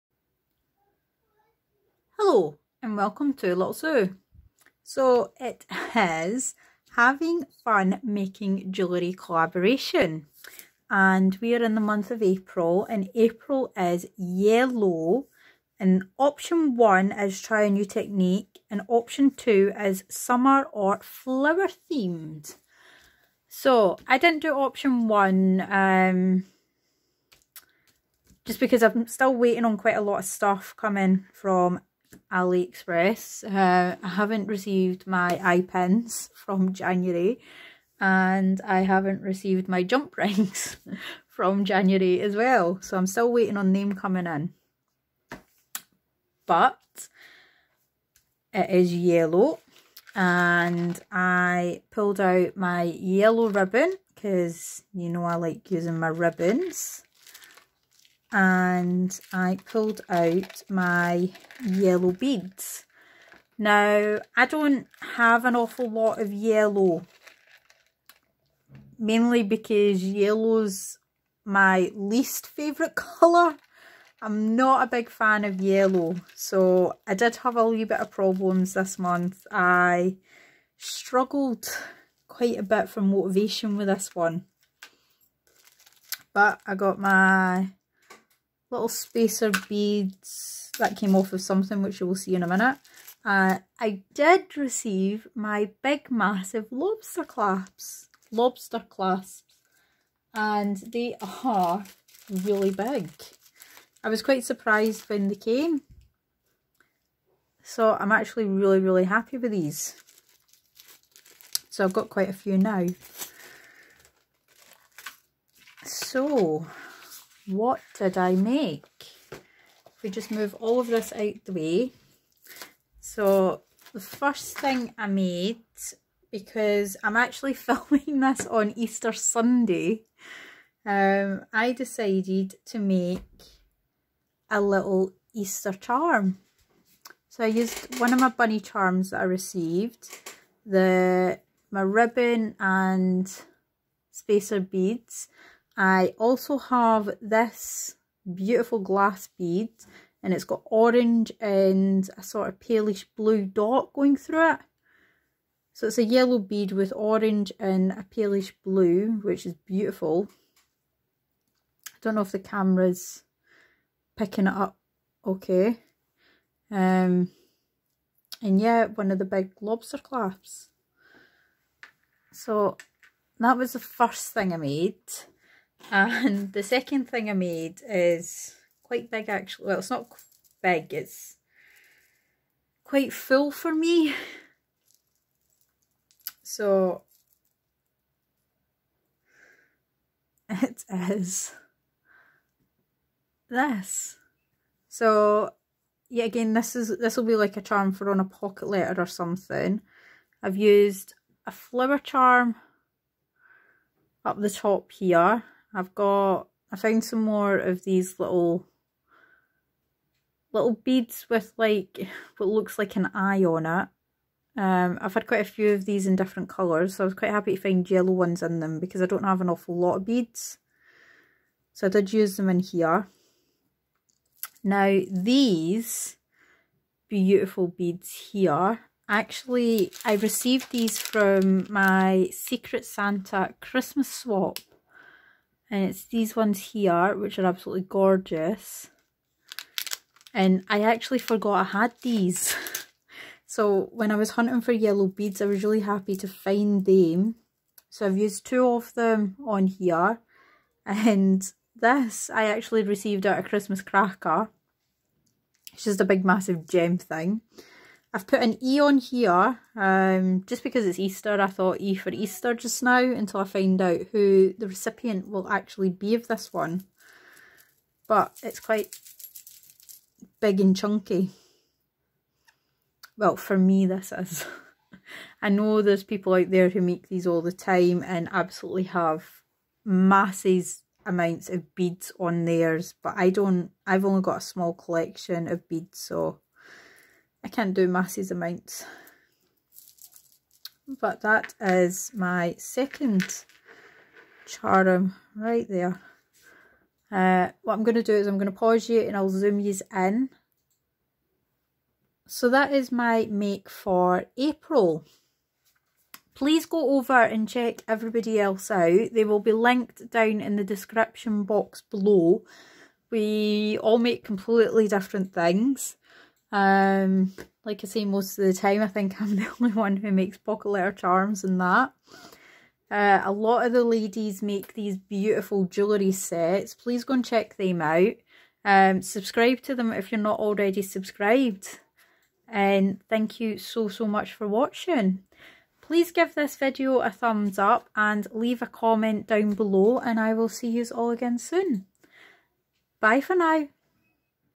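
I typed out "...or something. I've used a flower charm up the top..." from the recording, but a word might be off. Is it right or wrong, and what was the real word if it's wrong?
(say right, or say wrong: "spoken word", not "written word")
right.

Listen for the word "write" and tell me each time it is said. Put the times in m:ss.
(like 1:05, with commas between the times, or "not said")
not said.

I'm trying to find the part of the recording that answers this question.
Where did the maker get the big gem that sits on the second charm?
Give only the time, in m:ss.
4:13.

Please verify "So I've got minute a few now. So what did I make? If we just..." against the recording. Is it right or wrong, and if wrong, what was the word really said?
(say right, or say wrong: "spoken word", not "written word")
wrong: "quite", not "minute".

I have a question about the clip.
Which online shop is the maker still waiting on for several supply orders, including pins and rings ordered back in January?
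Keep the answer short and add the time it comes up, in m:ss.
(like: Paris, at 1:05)
AliExpress, at 0:32.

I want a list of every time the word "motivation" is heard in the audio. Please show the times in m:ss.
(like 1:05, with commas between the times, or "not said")
1:23.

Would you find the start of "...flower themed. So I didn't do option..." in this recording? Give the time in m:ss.
0:21.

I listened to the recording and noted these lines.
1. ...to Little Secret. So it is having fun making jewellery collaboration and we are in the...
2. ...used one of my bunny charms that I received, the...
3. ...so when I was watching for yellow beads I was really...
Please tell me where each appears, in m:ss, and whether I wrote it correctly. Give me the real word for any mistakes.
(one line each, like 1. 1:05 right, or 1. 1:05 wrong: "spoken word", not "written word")
1. 0:03 wrong: "Sue", not "Secret"
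2. 2:17 right
3. 4:03 wrong: "hunting", not "watching".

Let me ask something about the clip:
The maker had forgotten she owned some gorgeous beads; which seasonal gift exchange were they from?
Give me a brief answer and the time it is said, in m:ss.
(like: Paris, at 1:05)
Secret Santa Christmas swap, at 3:52.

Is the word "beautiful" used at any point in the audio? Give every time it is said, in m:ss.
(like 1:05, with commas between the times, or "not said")
2:28, 2:39, 3:47, 5:24.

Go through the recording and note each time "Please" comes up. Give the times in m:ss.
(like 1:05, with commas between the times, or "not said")
5:06, 5:26, 5:35.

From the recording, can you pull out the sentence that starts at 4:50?
But that is my second charm right there.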